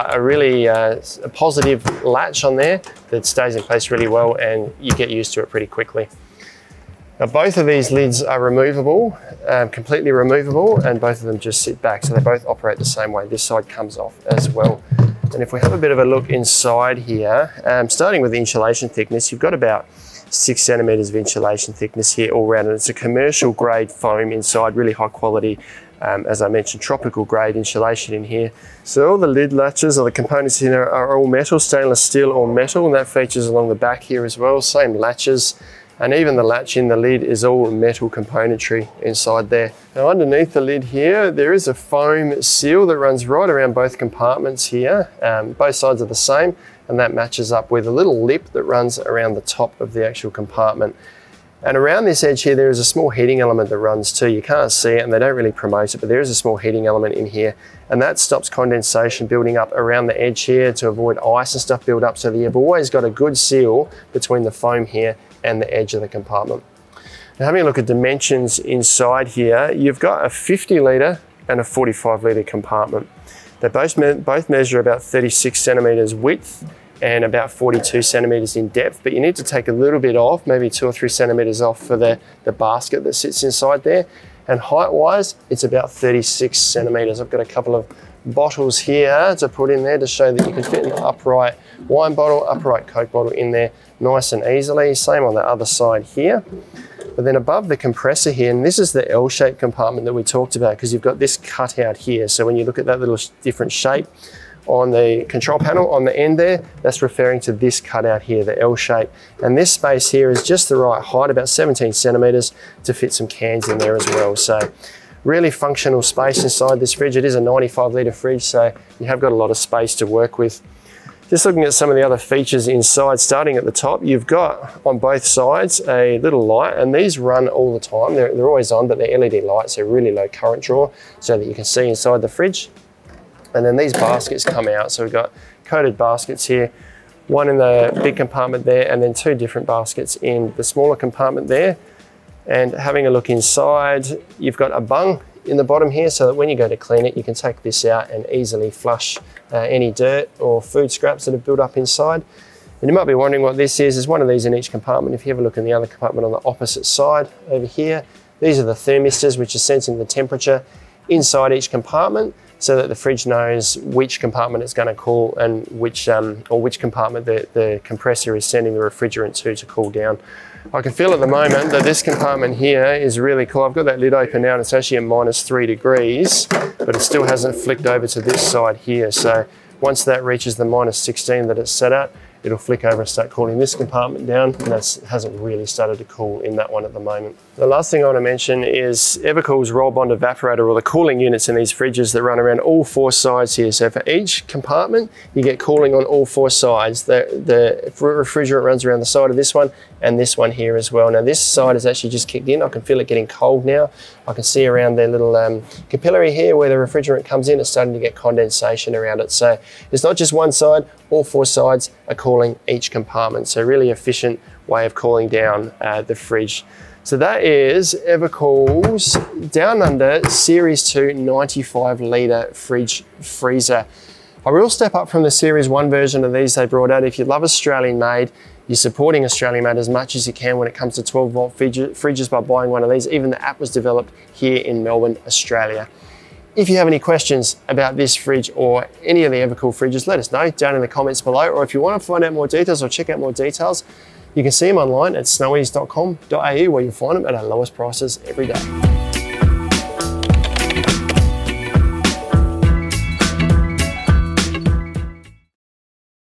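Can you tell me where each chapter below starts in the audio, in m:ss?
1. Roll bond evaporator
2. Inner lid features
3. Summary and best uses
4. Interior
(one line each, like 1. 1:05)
1. 3:06
2. 0:16
3. 3:36
4. 1:06.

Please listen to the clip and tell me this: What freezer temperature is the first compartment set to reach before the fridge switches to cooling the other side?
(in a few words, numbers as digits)
-16 degrees.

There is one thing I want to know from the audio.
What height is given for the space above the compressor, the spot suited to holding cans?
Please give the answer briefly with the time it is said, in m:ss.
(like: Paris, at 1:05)
17 centimeters, at 1:51.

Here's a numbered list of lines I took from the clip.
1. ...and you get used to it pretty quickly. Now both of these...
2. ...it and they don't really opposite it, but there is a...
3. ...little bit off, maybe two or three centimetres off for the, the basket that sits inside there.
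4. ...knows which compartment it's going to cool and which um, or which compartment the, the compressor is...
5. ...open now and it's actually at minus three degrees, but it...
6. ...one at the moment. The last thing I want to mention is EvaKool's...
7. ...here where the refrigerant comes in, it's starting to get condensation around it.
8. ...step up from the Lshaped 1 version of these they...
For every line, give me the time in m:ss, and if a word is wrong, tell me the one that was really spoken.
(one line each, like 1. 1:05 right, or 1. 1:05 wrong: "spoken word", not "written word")
1. 0:04 right
2. 0:54 wrong: "promote", not "opposite"
3. 1:19 right
4. 2:43 right
5. 2:54 right
6. 3:06 right
7. 3:26 right
8. 3:44 wrong: "Series", not "Lshaped".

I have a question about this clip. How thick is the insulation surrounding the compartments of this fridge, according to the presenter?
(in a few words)
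6 centimeters.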